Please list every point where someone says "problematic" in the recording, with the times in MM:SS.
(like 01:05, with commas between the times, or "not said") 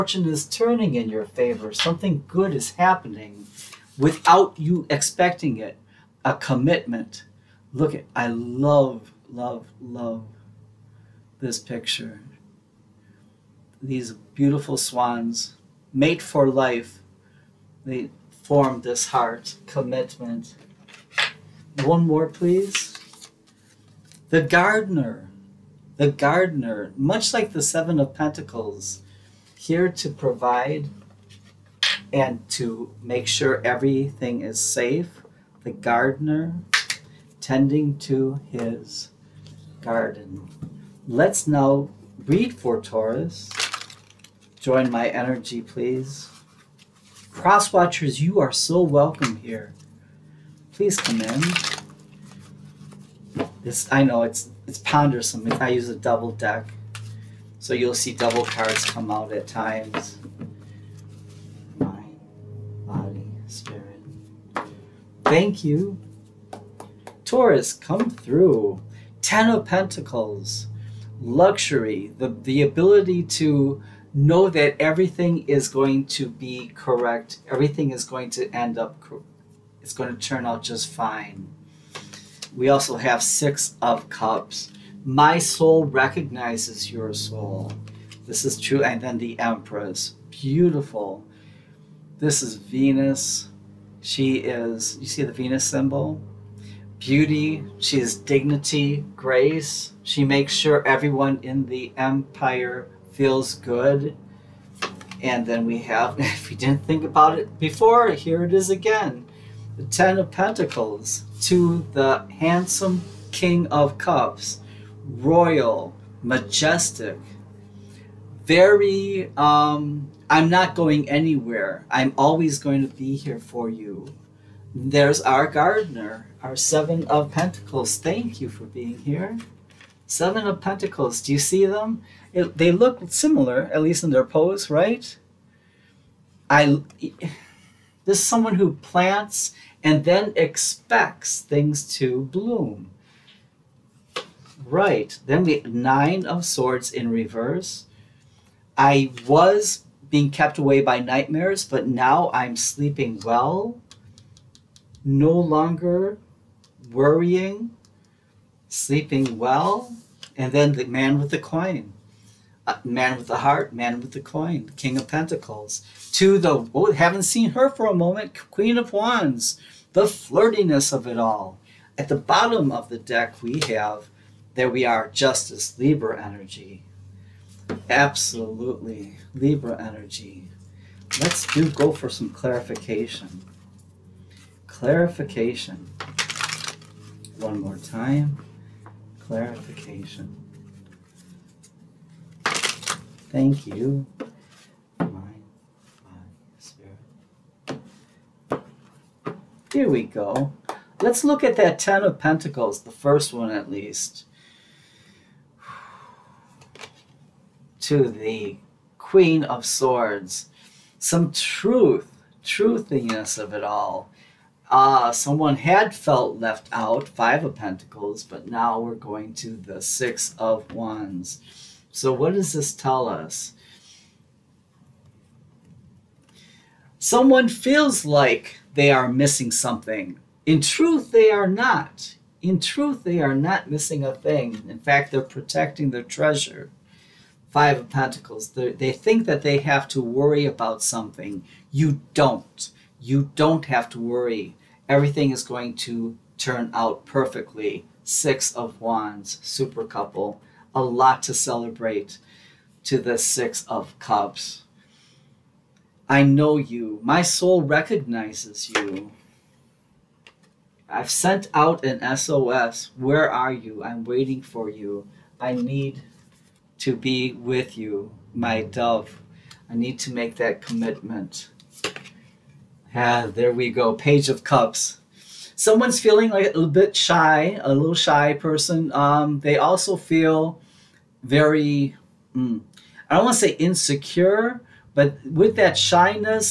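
not said.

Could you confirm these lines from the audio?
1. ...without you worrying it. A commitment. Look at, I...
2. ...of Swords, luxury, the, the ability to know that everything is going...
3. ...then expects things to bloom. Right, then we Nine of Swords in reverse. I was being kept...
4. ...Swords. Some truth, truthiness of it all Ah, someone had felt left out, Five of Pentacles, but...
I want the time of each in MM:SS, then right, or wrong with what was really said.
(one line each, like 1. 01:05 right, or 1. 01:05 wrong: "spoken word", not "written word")
1. 00:03 wrong: "expecting", not "worrying"
2. 01:09 wrong: "Pentacles", not "Swords"
3. 02:20 right
4. 03:29 right.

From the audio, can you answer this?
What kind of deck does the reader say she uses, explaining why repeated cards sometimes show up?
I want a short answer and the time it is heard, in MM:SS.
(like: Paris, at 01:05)
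Double deck, at 00:55.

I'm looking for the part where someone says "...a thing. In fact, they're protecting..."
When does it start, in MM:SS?
03:54.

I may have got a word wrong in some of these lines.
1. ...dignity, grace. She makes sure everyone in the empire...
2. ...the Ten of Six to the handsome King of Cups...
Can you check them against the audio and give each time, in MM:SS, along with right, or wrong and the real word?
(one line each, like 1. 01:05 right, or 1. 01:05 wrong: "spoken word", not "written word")
1. 01:38 right
2. 01:49 wrong: "Pentacles", not "Six".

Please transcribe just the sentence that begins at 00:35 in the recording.
The gardener tending to his garden.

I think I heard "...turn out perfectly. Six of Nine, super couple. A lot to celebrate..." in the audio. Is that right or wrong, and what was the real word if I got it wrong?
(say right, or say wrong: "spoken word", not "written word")
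wrong: "Wands", not "Nine".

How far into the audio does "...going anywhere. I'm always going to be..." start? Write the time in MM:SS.
02:00.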